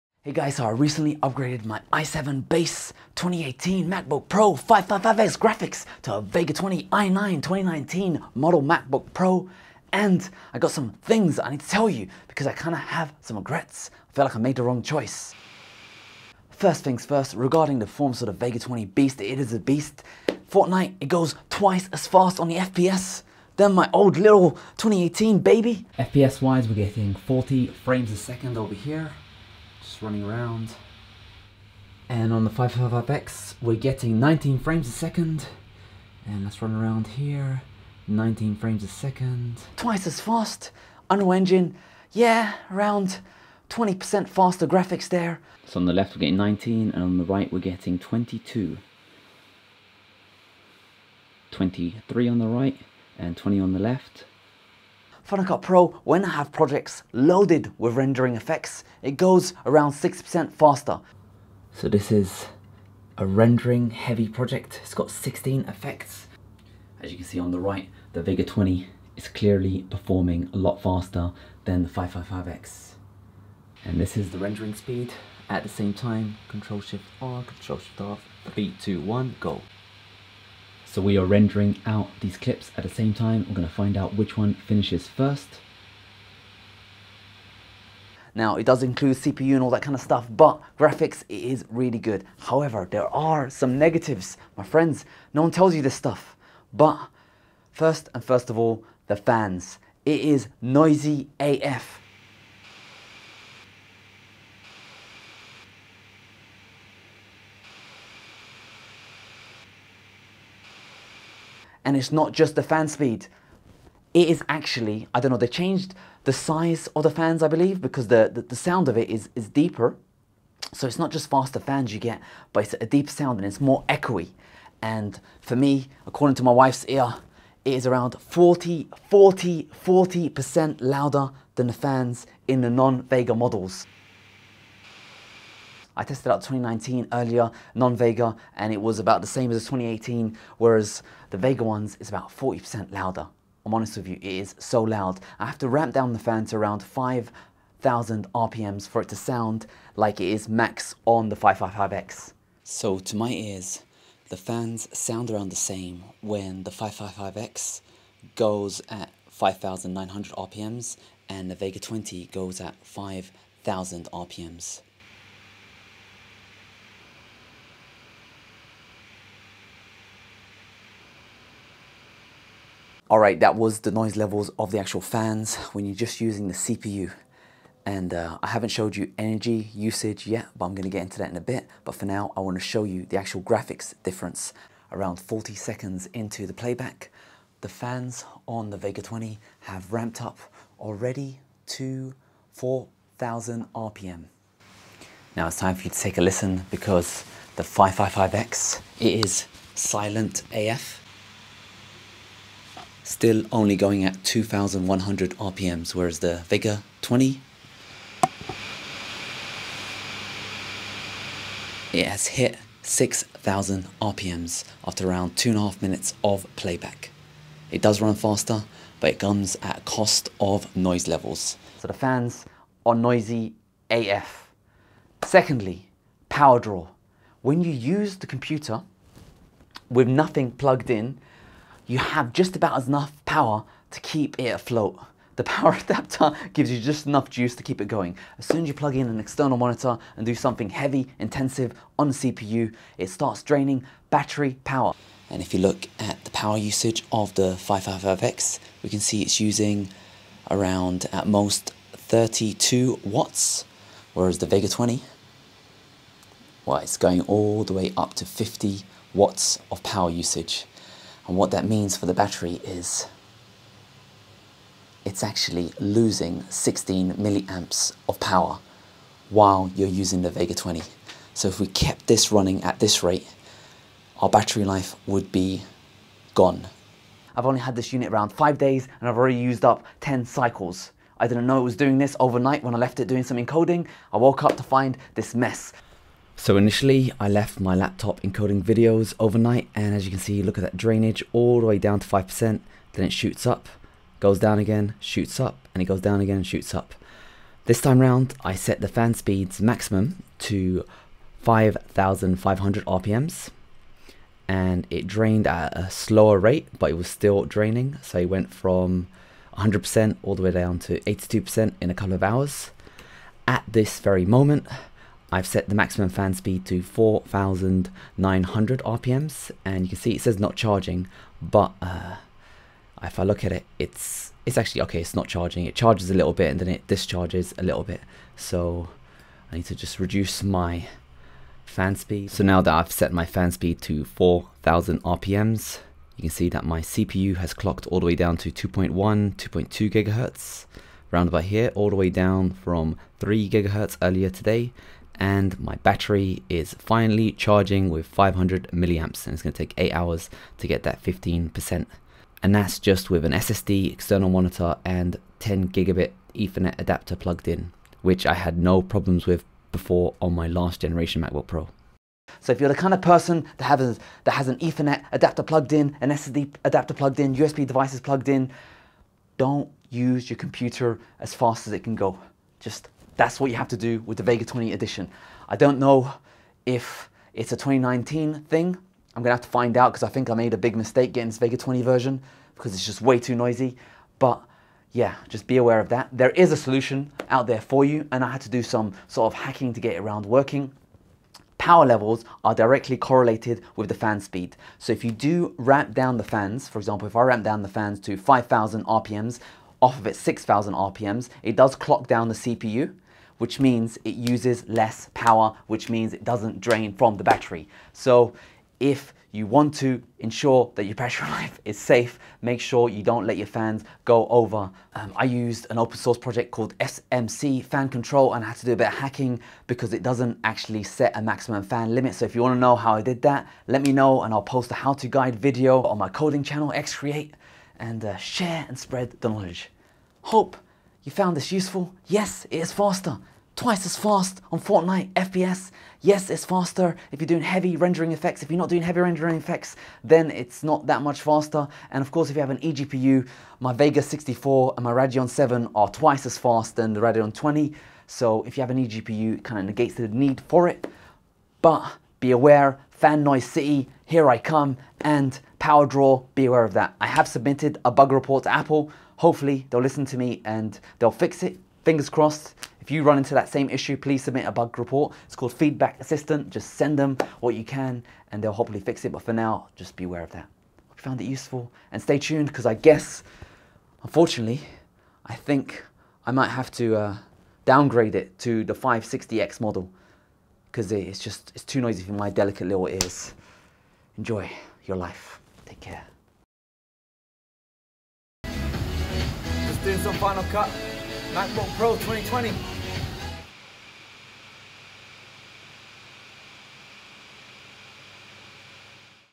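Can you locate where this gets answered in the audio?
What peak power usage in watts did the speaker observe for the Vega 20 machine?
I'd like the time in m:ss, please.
4:18.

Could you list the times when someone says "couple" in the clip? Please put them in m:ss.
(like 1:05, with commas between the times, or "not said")
5:11.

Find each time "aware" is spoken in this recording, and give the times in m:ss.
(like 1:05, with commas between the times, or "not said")
6:25, 7:32, 7:36, 7:50.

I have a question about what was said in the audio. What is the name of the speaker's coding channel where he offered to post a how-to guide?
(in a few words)
Xcreate.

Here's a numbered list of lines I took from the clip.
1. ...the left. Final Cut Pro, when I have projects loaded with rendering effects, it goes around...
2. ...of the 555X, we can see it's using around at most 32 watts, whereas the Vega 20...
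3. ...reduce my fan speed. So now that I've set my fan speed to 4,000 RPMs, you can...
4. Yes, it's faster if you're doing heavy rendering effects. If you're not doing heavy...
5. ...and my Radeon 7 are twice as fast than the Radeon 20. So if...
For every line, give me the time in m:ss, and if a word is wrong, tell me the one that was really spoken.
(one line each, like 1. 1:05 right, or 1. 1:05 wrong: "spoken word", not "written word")
1. 0:53 right
2. 4:07 right
3. 5:29 right
4. 7:16 right
5. 7:24 right.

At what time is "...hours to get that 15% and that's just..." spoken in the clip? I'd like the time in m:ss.
5:49.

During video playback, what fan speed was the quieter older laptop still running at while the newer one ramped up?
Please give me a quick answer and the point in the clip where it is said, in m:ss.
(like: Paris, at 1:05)
2100 RPM, at 3:24.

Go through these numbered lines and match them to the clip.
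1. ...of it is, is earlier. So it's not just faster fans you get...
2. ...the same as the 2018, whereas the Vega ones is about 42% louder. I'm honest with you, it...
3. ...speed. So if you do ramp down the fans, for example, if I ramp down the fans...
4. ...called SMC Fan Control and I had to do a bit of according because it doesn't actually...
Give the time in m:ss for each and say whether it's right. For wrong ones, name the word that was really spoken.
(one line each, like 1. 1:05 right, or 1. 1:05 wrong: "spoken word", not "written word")
1. 1:58 wrong: "deeper", not "earlier"
2. 2:19 wrong: "40", not "42"
3. 6:34 right
4. 6:56 wrong: "hacking", not "according".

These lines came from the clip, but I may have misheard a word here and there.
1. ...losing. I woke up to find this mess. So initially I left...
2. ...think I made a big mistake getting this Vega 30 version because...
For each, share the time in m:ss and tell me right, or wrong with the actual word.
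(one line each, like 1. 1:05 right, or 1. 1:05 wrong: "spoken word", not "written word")
1. 4:43 wrong: "encoding", not "losing"
2. 6:20 wrong: "20", not "30".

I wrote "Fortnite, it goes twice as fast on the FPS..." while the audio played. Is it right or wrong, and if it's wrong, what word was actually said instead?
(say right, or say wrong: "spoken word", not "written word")
right.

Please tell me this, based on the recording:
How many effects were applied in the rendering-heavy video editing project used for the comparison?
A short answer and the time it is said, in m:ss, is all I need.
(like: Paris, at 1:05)
16, at 1:05.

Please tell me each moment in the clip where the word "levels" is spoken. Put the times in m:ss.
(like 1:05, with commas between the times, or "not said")
2:54, 3:41, 6:31.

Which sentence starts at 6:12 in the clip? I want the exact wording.
Just that's what you have to do with the Vega 20 edition.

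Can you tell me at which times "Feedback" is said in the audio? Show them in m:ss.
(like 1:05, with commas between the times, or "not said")
7:45.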